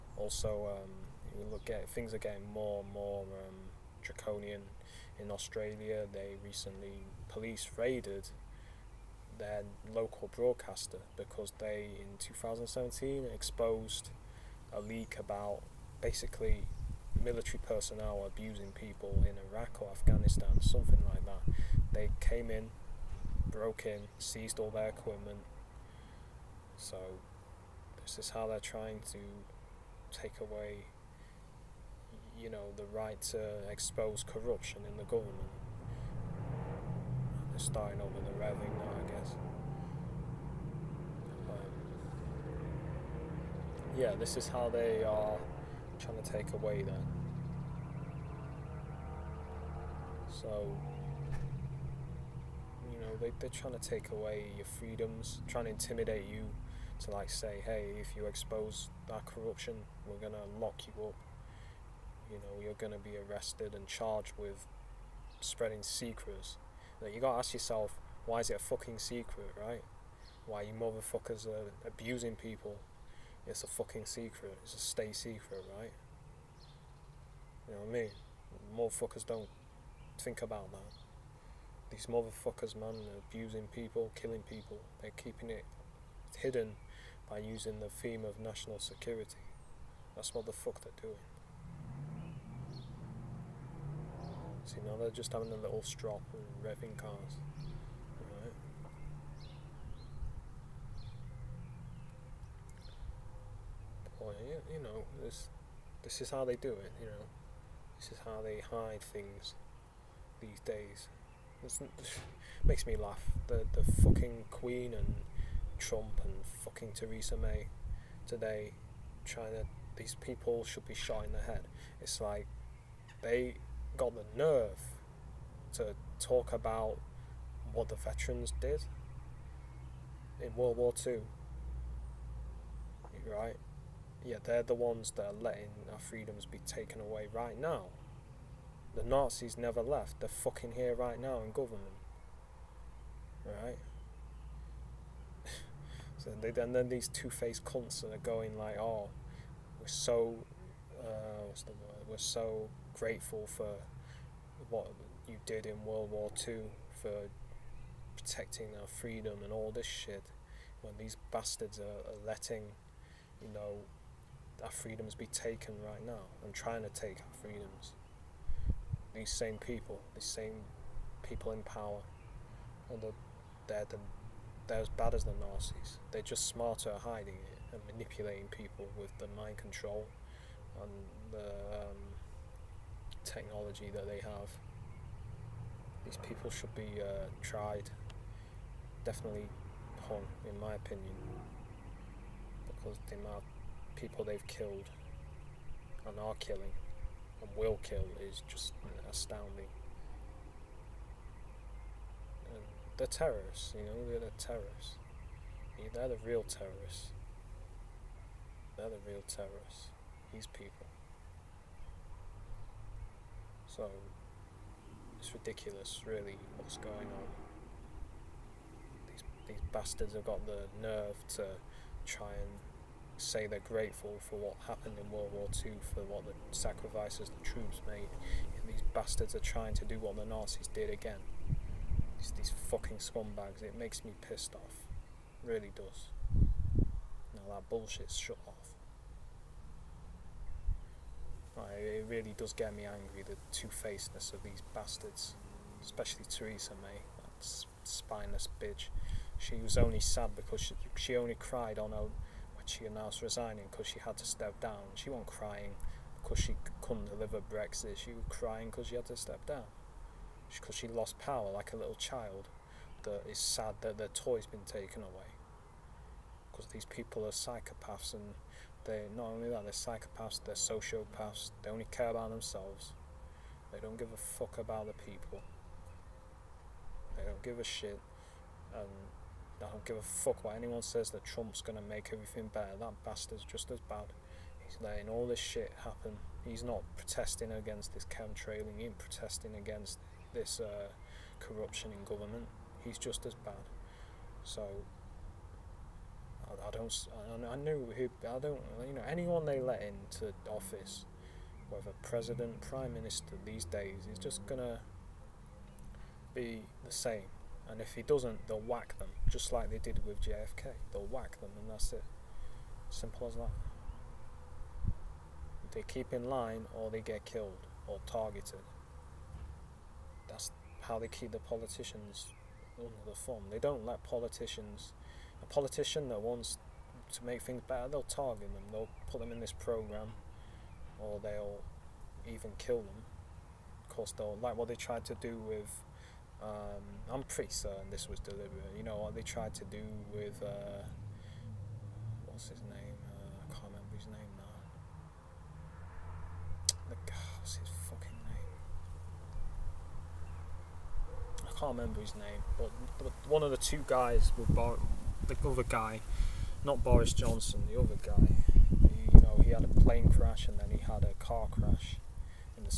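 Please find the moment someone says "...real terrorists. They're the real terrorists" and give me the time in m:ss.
3:26.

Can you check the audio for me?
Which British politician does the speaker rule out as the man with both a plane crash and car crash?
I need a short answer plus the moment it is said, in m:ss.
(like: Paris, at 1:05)
Boris Johnson, at 5:56.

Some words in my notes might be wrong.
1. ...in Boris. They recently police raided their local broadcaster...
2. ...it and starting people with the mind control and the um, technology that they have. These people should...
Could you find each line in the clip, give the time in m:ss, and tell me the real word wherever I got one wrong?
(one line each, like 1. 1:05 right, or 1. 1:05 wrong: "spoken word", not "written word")
1. 0:05 wrong: "Australia", not "Boris"
2. 2:57 wrong: "manipulating", not "starting".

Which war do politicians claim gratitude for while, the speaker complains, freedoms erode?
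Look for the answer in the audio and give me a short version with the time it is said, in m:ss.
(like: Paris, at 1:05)
World War Two, at 2:10.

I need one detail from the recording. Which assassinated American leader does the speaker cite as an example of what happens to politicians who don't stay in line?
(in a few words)
JFK.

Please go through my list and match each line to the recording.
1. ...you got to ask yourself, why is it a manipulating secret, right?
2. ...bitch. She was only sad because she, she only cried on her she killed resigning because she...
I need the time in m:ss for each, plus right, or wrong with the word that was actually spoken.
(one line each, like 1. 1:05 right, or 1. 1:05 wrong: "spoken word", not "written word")
1. 1:07 wrong: "fucking", not "manipulating"
2. 4:08 wrong: "announced", not "killed".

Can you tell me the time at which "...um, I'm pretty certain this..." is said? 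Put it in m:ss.
5:36.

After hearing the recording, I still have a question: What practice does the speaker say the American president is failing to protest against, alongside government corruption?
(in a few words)
chemtrailing.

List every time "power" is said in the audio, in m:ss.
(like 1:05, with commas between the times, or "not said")
2:51, 4:21.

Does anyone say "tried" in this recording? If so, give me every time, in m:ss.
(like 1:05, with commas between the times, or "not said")
3:07, 5:34, 5:39.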